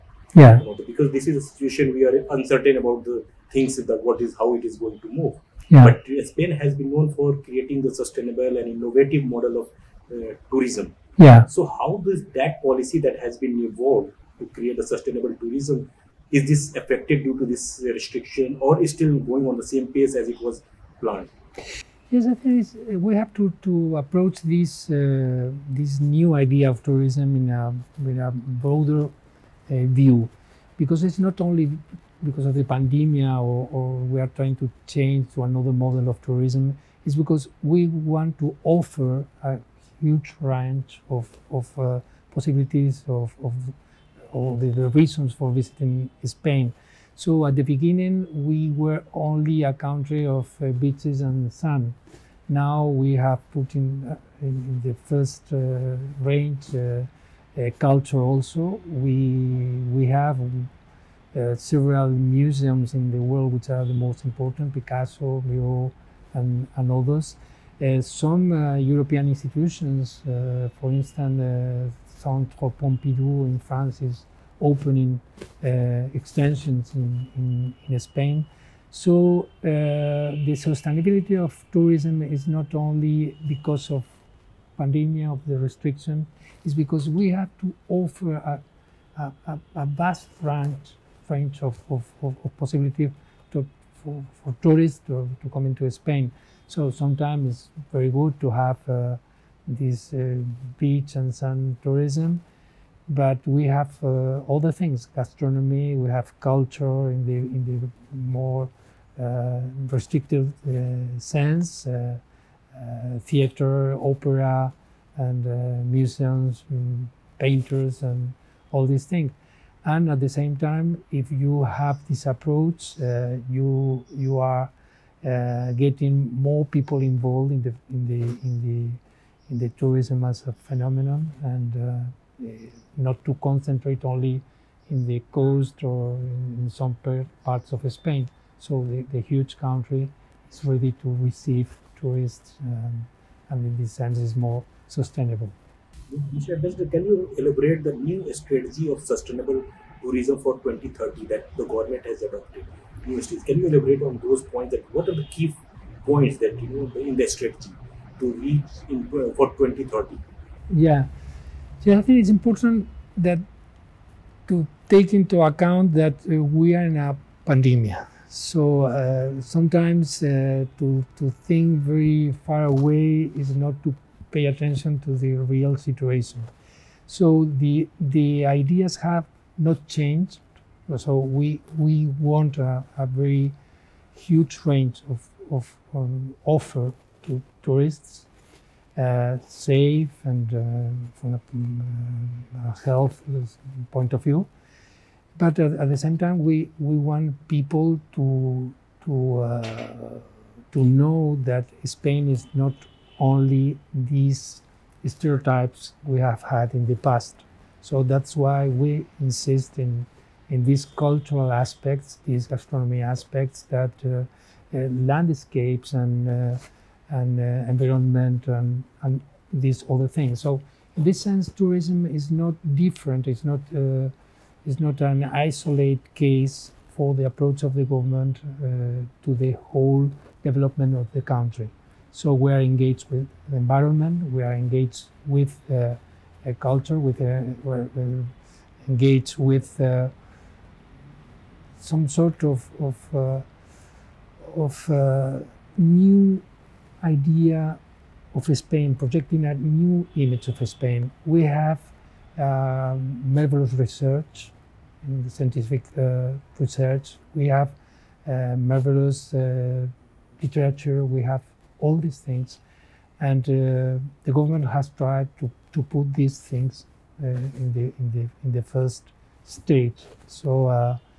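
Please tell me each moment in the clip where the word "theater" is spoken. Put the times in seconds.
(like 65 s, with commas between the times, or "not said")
113 s.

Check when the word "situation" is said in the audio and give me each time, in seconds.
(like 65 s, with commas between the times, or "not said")
1 s, 175 s.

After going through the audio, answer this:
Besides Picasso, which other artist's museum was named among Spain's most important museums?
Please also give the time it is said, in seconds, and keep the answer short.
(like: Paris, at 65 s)
Miro, at 65 s.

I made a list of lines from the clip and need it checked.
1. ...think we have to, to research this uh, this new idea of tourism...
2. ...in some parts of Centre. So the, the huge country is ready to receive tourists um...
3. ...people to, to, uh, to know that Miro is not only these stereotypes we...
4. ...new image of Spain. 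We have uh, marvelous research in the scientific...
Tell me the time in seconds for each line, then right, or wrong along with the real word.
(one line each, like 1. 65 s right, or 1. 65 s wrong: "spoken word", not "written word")
1. 22 s wrong: "approach", not "research"
2. 136 s wrong: "Spain", not "Centre"
3. 197 s wrong: "Spain", not "Miro"
4. 249 s right.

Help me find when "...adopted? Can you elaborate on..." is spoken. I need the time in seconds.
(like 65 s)
152 s.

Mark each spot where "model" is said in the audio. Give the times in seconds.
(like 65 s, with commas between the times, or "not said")
9 s, 35 s.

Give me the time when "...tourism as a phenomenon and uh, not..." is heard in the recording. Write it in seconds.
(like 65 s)
129 s.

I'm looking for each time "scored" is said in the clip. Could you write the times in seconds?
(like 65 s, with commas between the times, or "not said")
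not said.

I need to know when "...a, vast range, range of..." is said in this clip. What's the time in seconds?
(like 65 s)
89 s.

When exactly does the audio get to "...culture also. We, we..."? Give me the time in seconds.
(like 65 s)
57 s.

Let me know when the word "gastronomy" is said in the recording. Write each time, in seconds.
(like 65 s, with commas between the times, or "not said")
105 s, 212 s.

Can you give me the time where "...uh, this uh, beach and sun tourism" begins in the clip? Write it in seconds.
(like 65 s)
98 s.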